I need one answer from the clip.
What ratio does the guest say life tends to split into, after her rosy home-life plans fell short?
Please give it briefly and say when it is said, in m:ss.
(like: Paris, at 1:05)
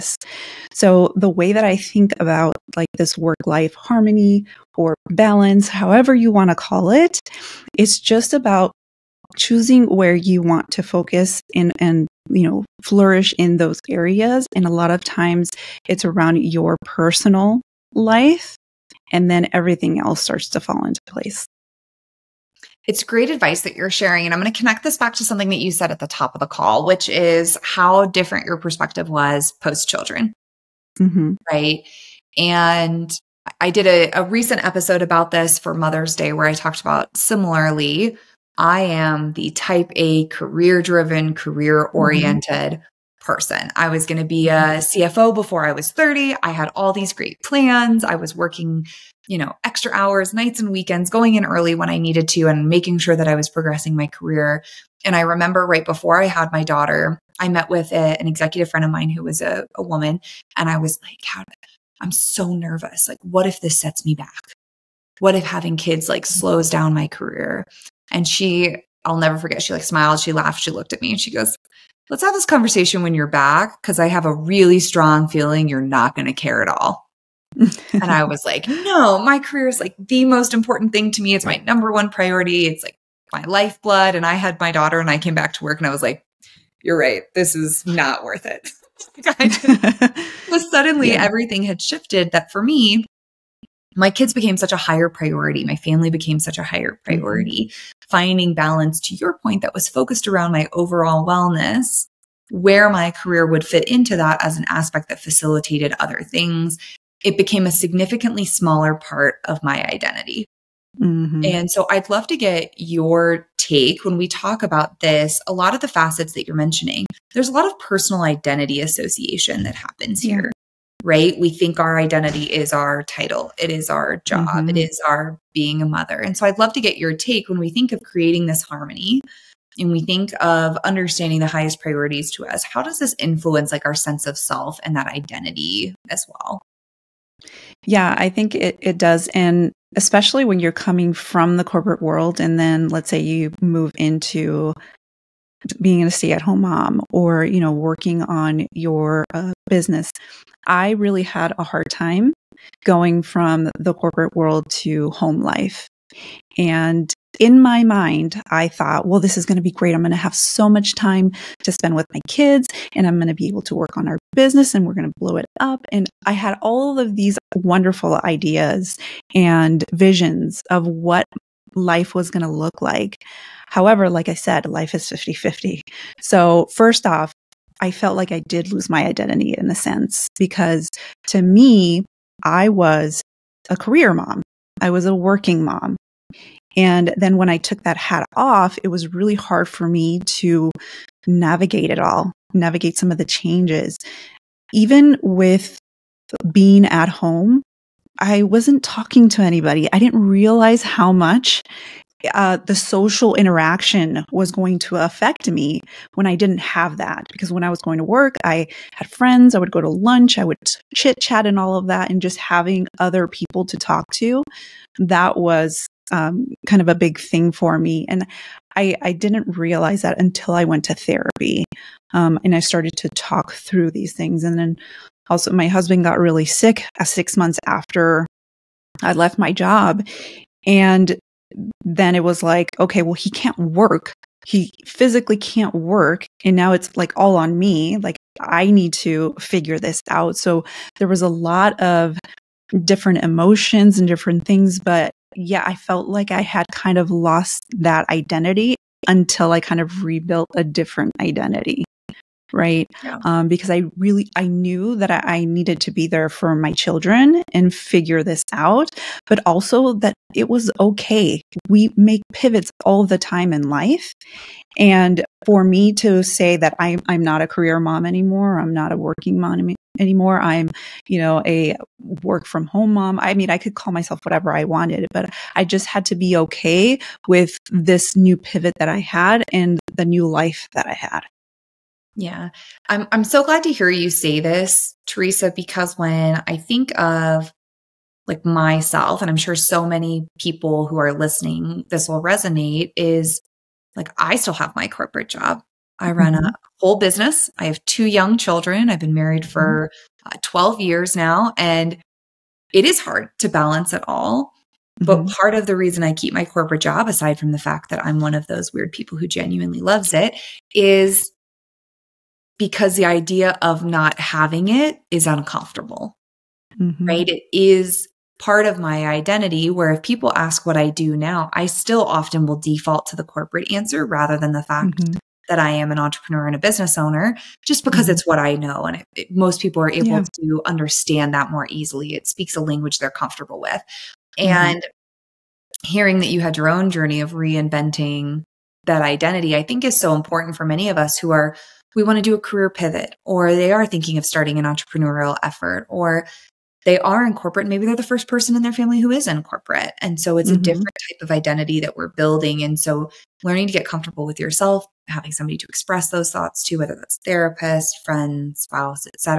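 50 50, at 2:55.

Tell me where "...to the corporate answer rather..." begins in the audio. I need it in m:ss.
5:23.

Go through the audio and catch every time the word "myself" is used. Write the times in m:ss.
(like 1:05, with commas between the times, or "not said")
4:33, 4:48.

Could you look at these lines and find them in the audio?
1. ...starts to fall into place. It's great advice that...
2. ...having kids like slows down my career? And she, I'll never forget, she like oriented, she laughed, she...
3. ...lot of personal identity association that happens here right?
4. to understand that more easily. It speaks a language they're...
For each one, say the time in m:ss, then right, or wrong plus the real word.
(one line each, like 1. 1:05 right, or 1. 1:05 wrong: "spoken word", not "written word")
1. 0:20 right
2. 1:05 wrong: "smiled", not "oriented"
3. 1:57 right
4. 5:30 right.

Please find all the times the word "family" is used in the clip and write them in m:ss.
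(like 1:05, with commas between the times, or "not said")
1:35, 5:48.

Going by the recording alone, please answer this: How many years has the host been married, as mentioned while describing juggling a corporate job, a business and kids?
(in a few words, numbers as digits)
12 years.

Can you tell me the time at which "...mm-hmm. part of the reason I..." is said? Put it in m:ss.
5:05.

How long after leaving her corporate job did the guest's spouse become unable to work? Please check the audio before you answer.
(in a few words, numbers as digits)
6 months.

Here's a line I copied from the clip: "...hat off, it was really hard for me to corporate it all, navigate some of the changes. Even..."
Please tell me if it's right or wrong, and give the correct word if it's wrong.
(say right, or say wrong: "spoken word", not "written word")
wrong: "navigate", not "corporate".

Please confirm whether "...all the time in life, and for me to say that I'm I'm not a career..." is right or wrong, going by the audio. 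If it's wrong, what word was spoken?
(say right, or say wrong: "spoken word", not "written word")
right.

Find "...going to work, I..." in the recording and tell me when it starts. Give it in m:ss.
3:27.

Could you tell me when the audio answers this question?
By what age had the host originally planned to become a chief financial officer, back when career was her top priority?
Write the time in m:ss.
0:45.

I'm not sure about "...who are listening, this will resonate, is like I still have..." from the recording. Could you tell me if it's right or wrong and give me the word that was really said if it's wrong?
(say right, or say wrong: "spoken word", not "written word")
right.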